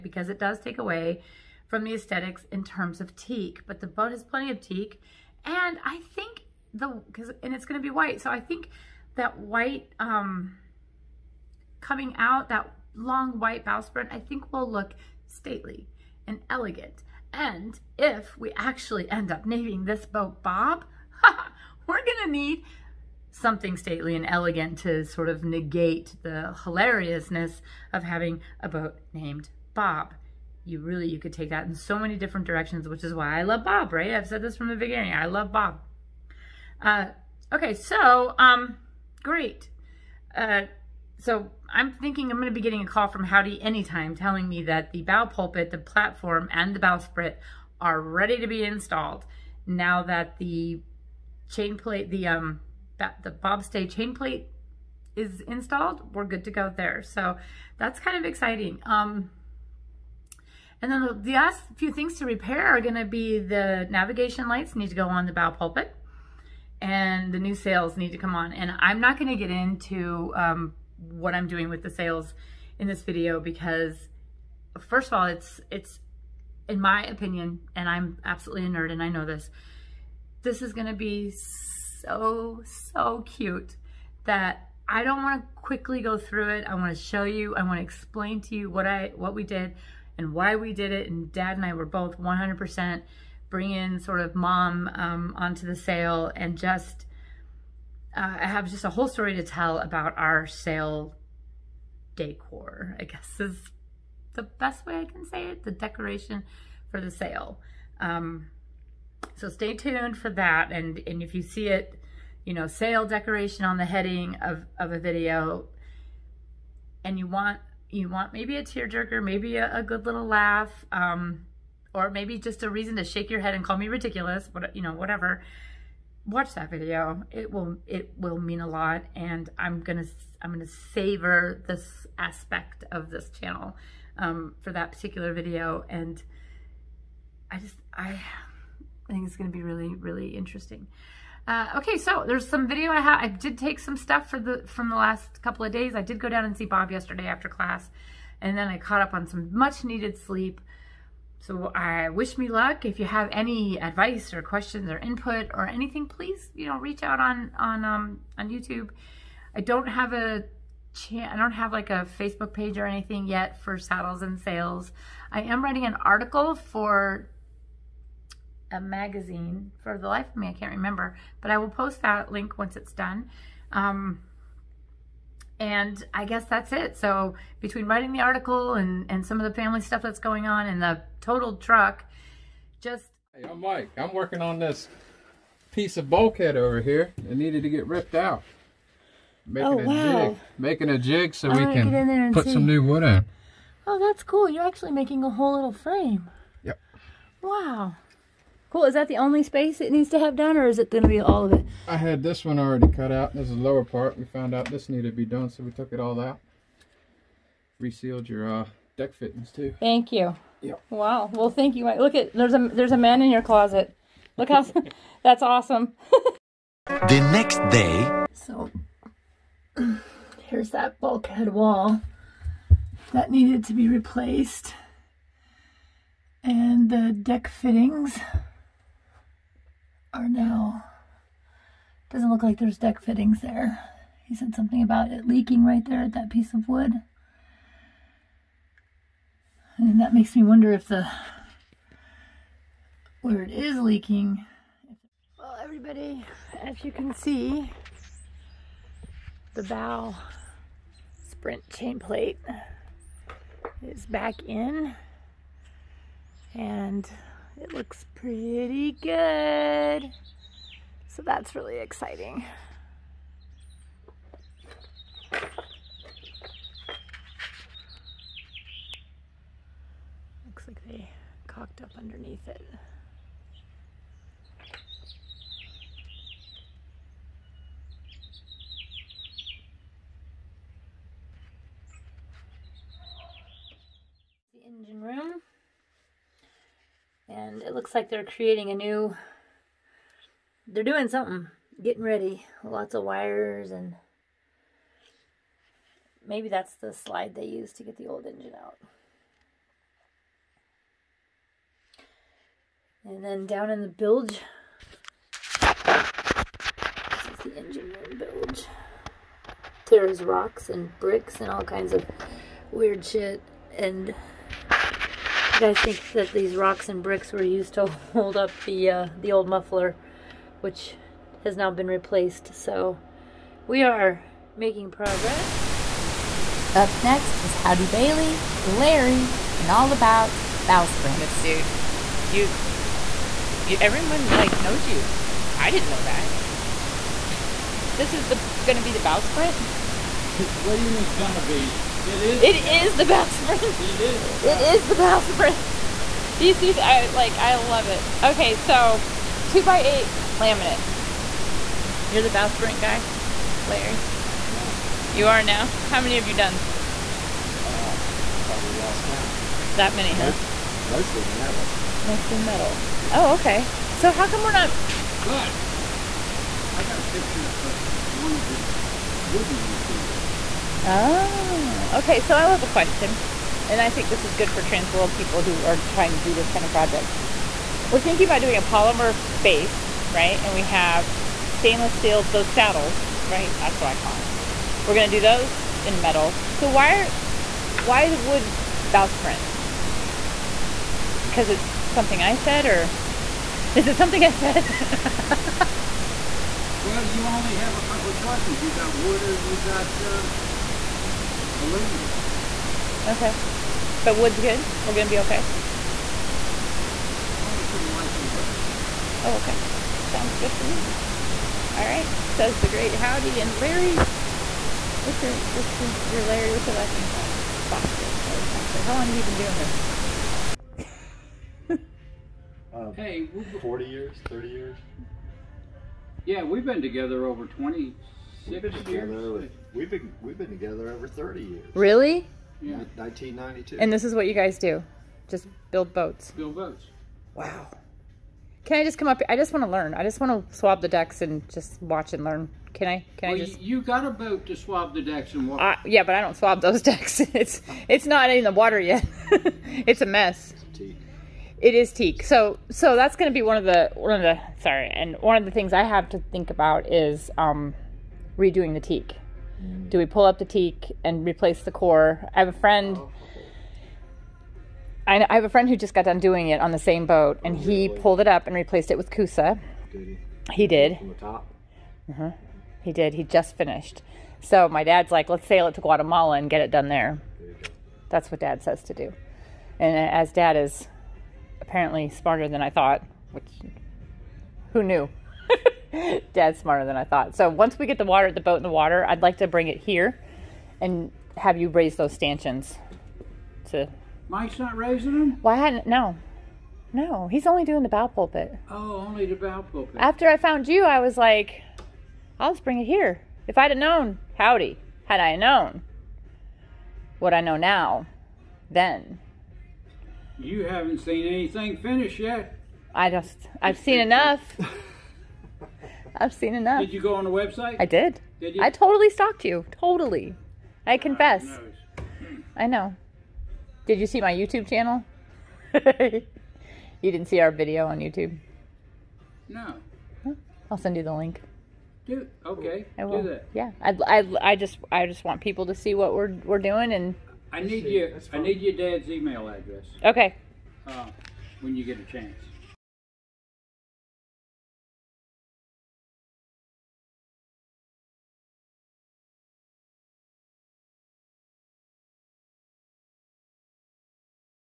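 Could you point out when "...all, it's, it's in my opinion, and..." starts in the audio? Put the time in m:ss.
1:15.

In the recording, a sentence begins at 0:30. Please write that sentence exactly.
You really, you could take that in so many different directions, which is why I love Bob, right?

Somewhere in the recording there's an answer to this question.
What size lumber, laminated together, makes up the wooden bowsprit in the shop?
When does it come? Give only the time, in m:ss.
5:49.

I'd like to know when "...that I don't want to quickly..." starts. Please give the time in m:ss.
1:24.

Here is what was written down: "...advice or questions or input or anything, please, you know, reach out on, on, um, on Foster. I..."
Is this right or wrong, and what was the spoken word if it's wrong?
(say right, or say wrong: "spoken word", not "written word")
wrong: "YouTube", not "Foster".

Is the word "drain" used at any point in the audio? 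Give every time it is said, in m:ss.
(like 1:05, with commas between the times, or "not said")
not said.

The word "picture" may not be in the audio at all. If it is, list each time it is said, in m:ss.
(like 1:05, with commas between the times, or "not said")
6:07.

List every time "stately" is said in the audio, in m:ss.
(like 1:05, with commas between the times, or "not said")
0:15, 0:23.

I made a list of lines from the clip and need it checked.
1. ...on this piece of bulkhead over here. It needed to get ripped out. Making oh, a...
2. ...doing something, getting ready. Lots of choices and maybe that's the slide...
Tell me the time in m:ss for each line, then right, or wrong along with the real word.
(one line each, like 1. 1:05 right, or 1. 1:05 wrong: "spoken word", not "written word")
1. 3:04 right
2. 4:50 wrong: "wires", not "choices".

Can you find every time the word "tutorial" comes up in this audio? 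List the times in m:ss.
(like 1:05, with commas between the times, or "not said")
not said.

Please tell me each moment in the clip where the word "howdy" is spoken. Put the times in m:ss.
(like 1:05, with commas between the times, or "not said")
0:43, 5:27, 6:52, 8:24.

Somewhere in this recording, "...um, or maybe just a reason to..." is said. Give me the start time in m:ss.
2:00.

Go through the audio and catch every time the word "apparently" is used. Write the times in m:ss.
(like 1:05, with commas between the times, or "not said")
8:01.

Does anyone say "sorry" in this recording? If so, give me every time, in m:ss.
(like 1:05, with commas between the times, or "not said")
7:34.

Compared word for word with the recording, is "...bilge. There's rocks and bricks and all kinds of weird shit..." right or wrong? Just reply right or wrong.
right.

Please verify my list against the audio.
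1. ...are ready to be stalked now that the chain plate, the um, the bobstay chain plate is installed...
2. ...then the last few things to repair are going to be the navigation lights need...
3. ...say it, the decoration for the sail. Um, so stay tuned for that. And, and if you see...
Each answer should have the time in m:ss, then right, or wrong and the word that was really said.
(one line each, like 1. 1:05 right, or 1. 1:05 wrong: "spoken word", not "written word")
1. 0:47 wrong: "installed", not "stalked"
2. 1:00 right
3. 1:45 right.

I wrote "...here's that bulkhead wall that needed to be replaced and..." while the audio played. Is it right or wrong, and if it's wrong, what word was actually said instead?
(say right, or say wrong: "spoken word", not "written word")
right.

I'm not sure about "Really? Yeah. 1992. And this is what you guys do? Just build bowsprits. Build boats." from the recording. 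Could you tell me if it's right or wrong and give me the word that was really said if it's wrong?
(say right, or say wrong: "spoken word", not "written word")
wrong: "boats", not "bowsprits".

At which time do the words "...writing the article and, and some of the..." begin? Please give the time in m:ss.
2:57.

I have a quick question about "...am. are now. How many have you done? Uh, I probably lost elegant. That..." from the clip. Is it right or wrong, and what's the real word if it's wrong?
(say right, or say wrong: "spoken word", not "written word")
wrong: "count", not "elegant".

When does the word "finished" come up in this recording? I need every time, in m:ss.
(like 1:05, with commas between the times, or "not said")
7:53, 8:31.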